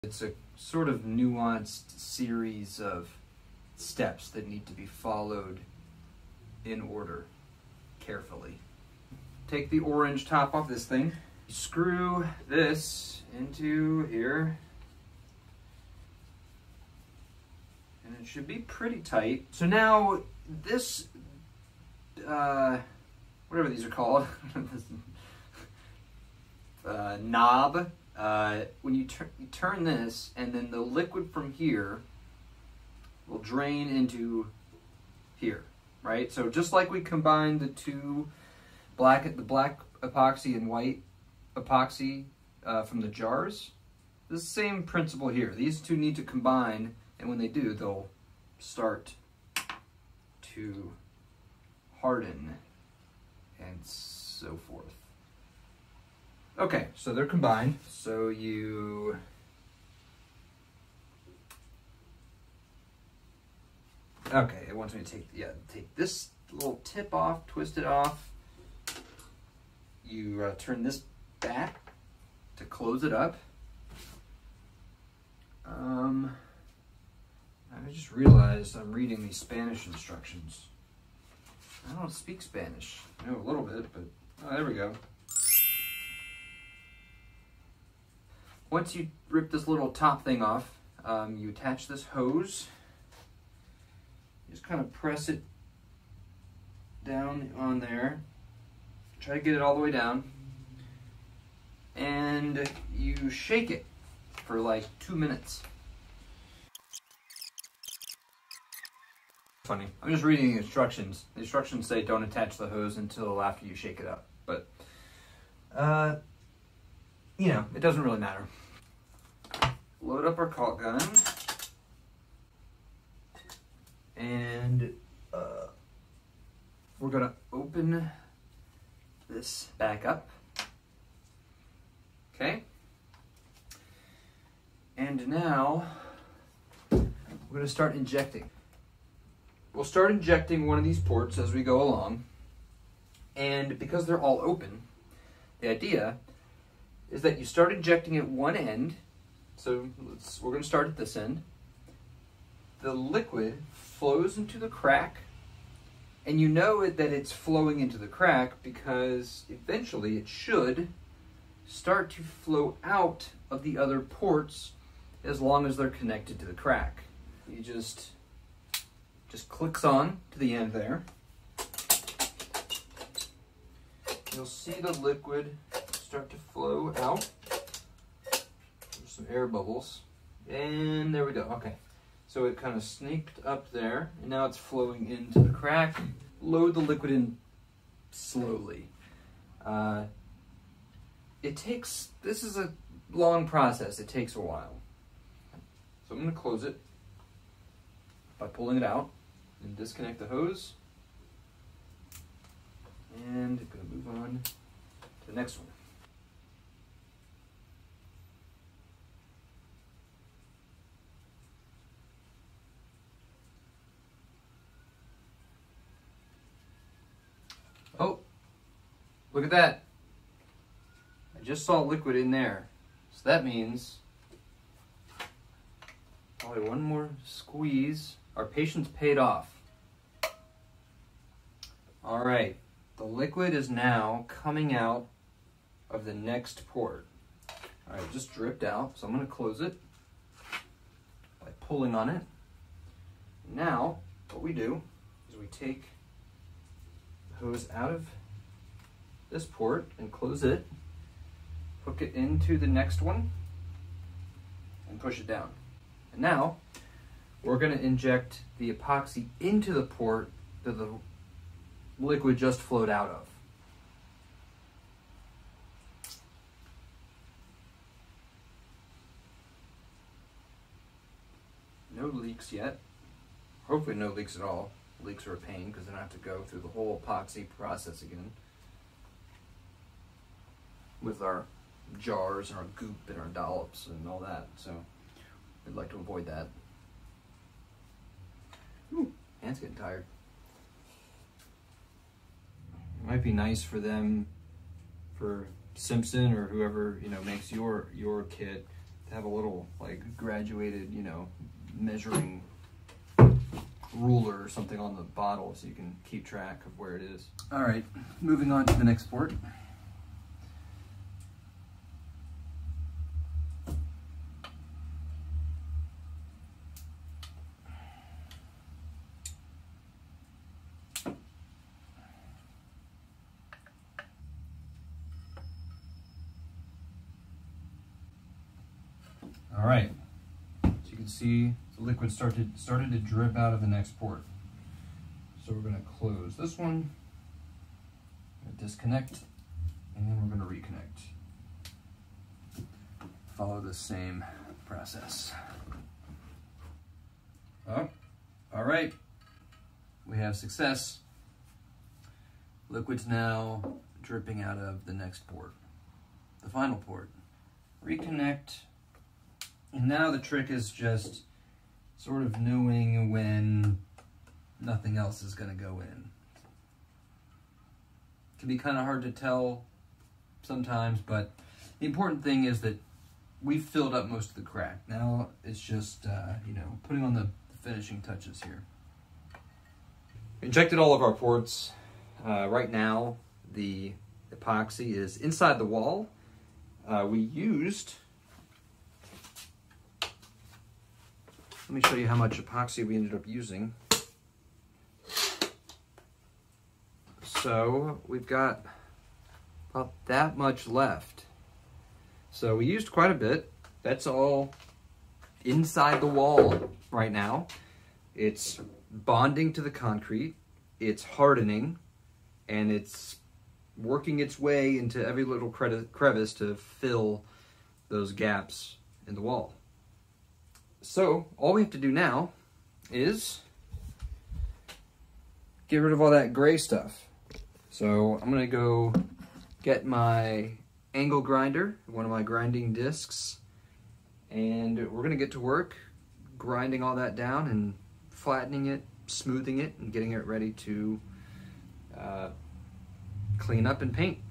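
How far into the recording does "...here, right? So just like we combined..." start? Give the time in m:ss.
0:35.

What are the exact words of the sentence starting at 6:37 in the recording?
So we've got about that much left.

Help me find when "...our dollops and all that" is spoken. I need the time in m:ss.
4:43.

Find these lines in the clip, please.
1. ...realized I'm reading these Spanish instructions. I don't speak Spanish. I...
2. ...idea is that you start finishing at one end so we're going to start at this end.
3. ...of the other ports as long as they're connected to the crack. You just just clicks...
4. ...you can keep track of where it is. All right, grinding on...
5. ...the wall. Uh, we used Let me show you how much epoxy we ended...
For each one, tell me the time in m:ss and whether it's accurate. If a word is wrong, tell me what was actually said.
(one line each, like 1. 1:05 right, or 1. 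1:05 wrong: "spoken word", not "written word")
1. 1:18 right
2. 2:25 wrong: "injecting", not "finishing"
3. 2:43 right
4. 5:05 wrong: "moving", not "grinding"
5. 6:25 right.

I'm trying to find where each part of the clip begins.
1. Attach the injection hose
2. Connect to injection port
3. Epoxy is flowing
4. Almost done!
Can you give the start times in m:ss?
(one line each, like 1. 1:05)
1. 1:40
2. 2:20
3. 3:50
4. 6:25.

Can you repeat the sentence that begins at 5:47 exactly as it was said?
Oh, all right, we have success.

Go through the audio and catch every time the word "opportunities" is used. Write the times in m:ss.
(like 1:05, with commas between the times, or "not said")
not said.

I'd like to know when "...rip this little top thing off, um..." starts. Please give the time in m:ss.
1:29.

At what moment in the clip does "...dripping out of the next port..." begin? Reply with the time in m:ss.
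5:54.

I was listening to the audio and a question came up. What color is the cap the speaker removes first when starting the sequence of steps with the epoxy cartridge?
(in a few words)
orange.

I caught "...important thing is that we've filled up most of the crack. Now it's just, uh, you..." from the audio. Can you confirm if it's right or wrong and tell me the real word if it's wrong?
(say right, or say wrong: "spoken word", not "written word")
right.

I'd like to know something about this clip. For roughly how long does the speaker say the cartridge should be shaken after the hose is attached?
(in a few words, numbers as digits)
2 minutes.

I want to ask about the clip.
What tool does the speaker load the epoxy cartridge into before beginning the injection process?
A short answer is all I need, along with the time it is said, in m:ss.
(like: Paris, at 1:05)
caulk gun, at 2:00.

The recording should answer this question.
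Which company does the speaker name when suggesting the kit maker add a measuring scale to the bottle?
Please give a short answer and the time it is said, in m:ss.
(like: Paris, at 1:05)
Simpson, at 4:55.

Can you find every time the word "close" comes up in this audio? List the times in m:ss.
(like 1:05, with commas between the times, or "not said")
1:12, 3:16, 3:59, 4:10, 5:35.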